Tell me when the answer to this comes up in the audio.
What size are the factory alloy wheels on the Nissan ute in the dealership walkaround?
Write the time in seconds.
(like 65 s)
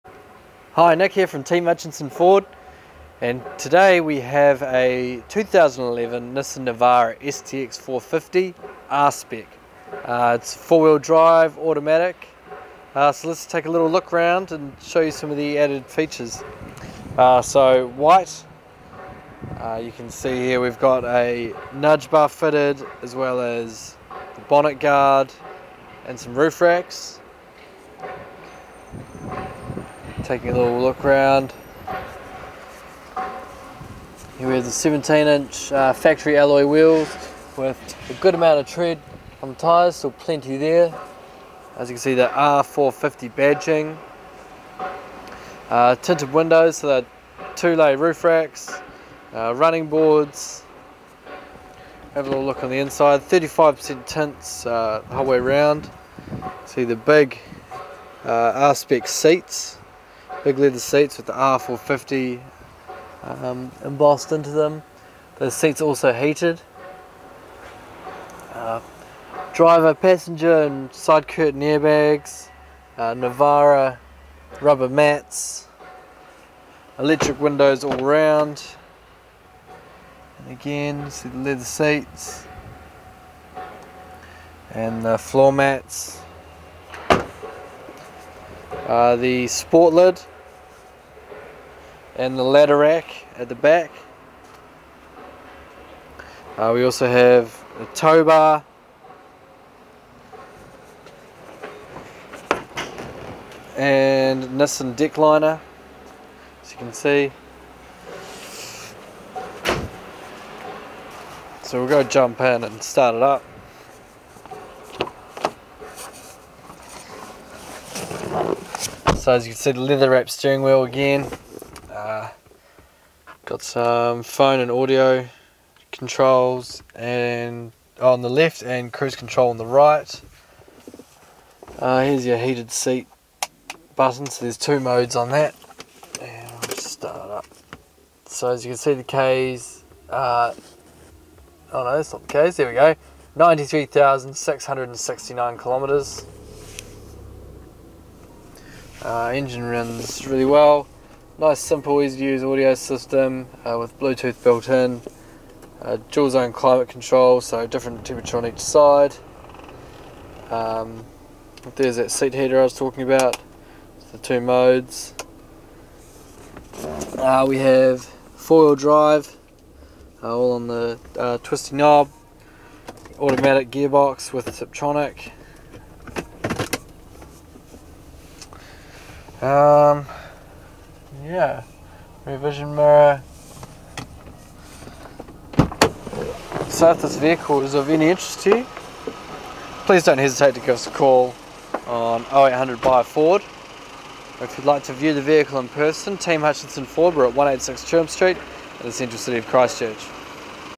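34 s.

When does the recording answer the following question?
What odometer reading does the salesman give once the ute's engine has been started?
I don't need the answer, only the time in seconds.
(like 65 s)
143 s.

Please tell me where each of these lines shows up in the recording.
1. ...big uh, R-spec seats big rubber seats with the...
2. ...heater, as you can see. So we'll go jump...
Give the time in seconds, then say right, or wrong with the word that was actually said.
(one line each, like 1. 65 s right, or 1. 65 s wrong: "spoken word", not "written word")
1. 56 s wrong: "leather", not "rubber"
2. 105 s wrong: "liner", not "heater".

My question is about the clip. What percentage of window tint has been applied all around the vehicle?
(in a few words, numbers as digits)
35%.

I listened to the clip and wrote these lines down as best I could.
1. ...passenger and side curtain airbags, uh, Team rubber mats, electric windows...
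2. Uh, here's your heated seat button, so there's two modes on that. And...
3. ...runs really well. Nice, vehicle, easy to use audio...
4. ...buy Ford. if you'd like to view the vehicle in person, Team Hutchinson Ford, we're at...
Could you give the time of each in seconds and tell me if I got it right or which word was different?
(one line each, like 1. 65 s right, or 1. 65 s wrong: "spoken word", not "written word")
1. 69 s wrong: "Navara", not "Team"
2. 131 s right
3. 149 s wrong: "simple", not "vehicle"
4. 192 s right.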